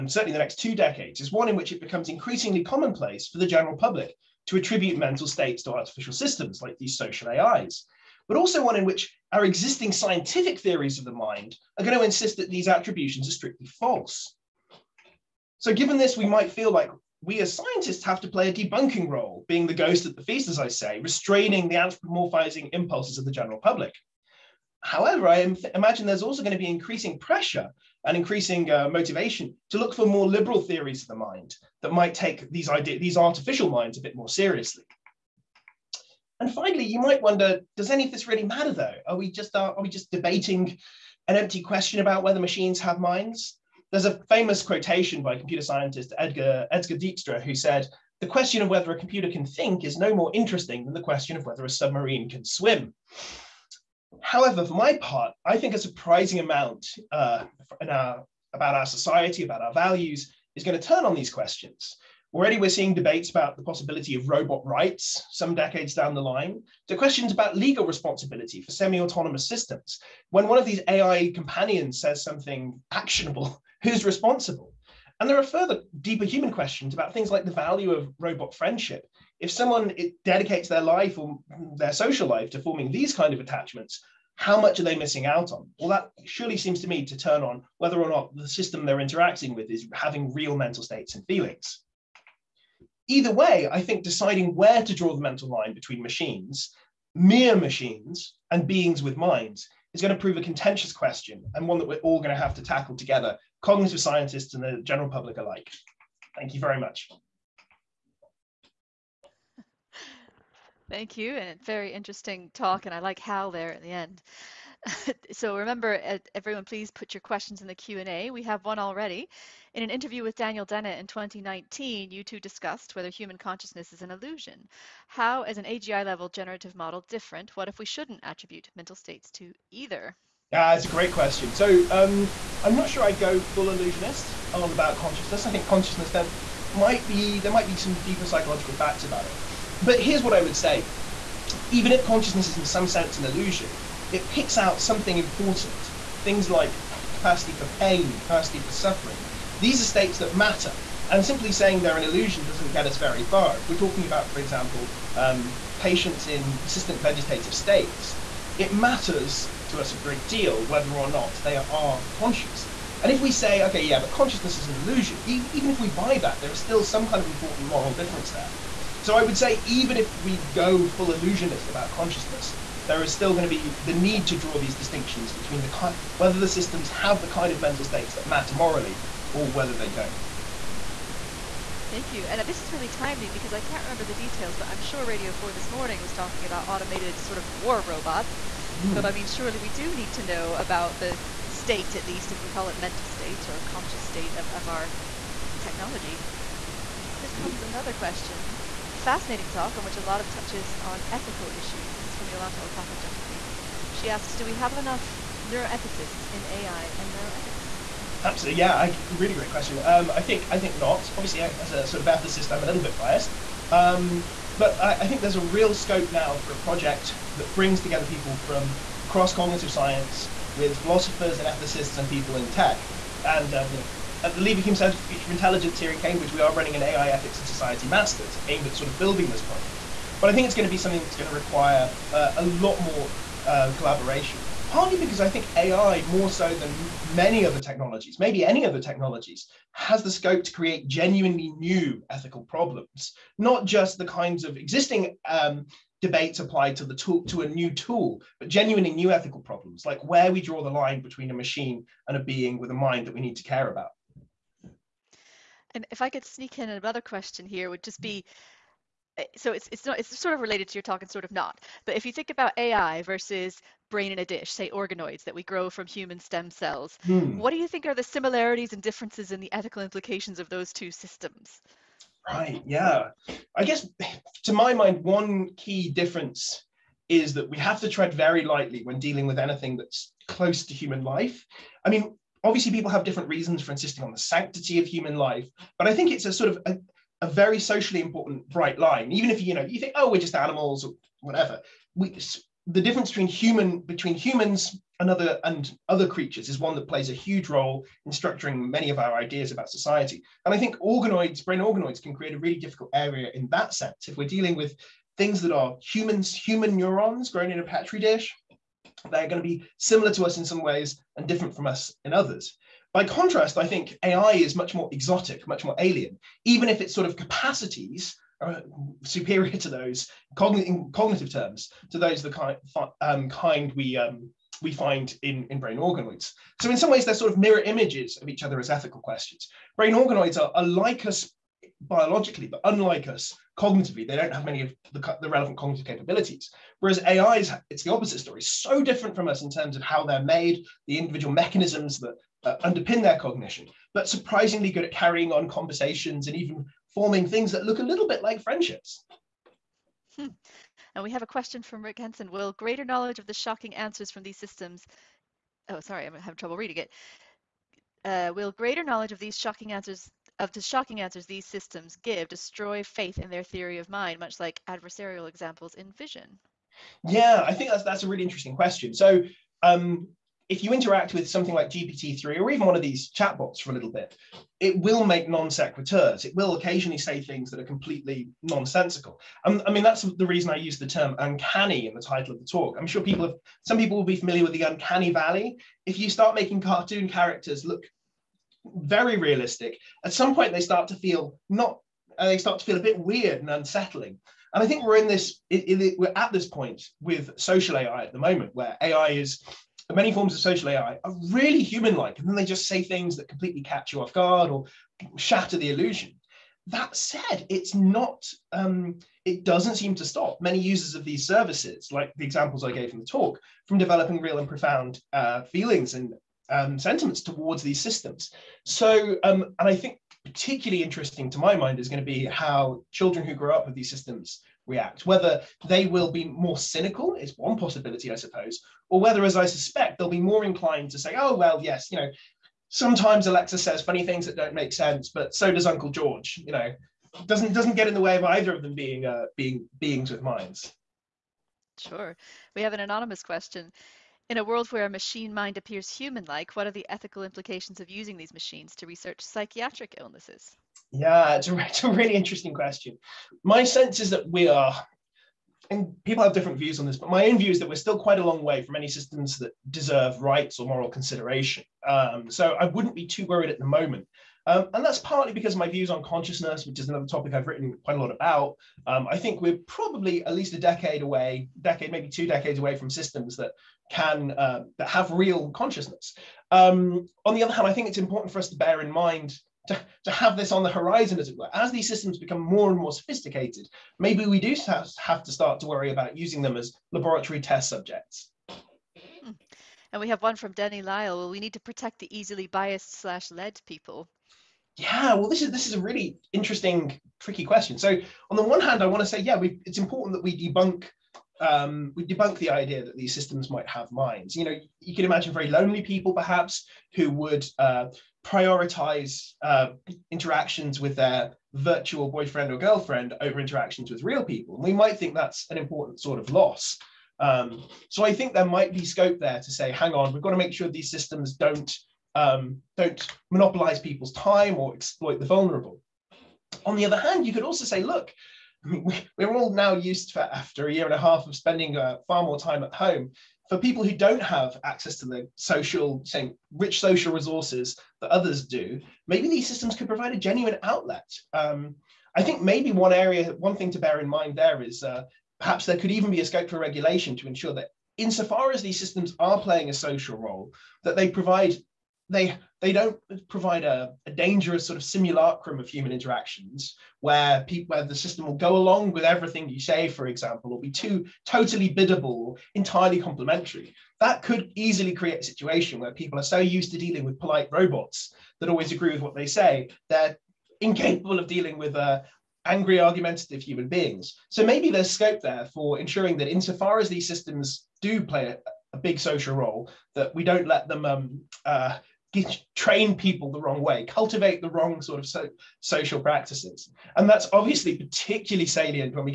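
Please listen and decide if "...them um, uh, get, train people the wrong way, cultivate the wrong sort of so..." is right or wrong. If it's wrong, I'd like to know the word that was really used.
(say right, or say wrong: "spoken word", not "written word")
right.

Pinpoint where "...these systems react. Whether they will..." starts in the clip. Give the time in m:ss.
7:03.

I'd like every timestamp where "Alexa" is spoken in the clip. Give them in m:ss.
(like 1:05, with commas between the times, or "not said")
7:13.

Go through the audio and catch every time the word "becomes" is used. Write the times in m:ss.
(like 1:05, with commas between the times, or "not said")
0:01, 8:02.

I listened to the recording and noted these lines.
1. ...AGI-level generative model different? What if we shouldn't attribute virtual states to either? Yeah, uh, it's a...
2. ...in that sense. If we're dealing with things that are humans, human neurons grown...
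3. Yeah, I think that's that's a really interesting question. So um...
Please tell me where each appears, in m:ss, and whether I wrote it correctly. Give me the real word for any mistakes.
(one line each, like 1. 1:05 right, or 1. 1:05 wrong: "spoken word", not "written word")
1. 2:05 wrong: "mental", not "virtual"
2. 5:03 right
3. 6:07 right.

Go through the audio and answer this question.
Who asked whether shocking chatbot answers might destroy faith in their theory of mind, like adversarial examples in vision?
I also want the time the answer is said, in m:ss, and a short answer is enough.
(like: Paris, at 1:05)
Rik Henson, at 5:51.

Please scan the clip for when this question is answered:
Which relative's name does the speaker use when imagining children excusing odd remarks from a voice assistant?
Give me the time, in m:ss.
7:15.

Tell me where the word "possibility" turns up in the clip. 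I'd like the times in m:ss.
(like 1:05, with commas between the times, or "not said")
1:03, 7:07.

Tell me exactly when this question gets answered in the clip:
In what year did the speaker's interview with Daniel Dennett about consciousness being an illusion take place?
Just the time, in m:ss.
2:01.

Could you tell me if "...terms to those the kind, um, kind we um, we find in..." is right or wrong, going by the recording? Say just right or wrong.
right.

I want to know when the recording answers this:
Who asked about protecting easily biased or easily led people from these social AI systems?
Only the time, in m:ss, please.
8:10.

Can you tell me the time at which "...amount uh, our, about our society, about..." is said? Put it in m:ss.
0:56.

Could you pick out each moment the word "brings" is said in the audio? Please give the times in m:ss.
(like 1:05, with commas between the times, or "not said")
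3:37.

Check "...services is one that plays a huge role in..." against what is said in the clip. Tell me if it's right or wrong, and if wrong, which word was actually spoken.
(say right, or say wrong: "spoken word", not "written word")
wrong: "creatures", not "services".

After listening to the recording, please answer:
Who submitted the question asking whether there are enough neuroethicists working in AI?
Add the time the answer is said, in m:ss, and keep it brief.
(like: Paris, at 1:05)
Yolanta Opaka Jeffrey, at 3:22.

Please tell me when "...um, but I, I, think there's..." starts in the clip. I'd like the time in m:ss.
3:33.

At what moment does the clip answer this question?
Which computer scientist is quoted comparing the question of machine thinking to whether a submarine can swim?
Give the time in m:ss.
0:46.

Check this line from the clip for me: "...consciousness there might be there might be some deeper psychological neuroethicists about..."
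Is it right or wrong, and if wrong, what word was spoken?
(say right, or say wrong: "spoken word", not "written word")
wrong: "facts", not "neuroethicists".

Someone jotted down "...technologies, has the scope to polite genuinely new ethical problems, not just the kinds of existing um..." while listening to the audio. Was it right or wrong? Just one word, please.
wrong.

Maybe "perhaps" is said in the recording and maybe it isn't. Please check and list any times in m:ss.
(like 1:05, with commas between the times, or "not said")
8:26, 9:05.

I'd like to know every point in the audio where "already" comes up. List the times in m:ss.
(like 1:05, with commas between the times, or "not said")
1:02, 1:58.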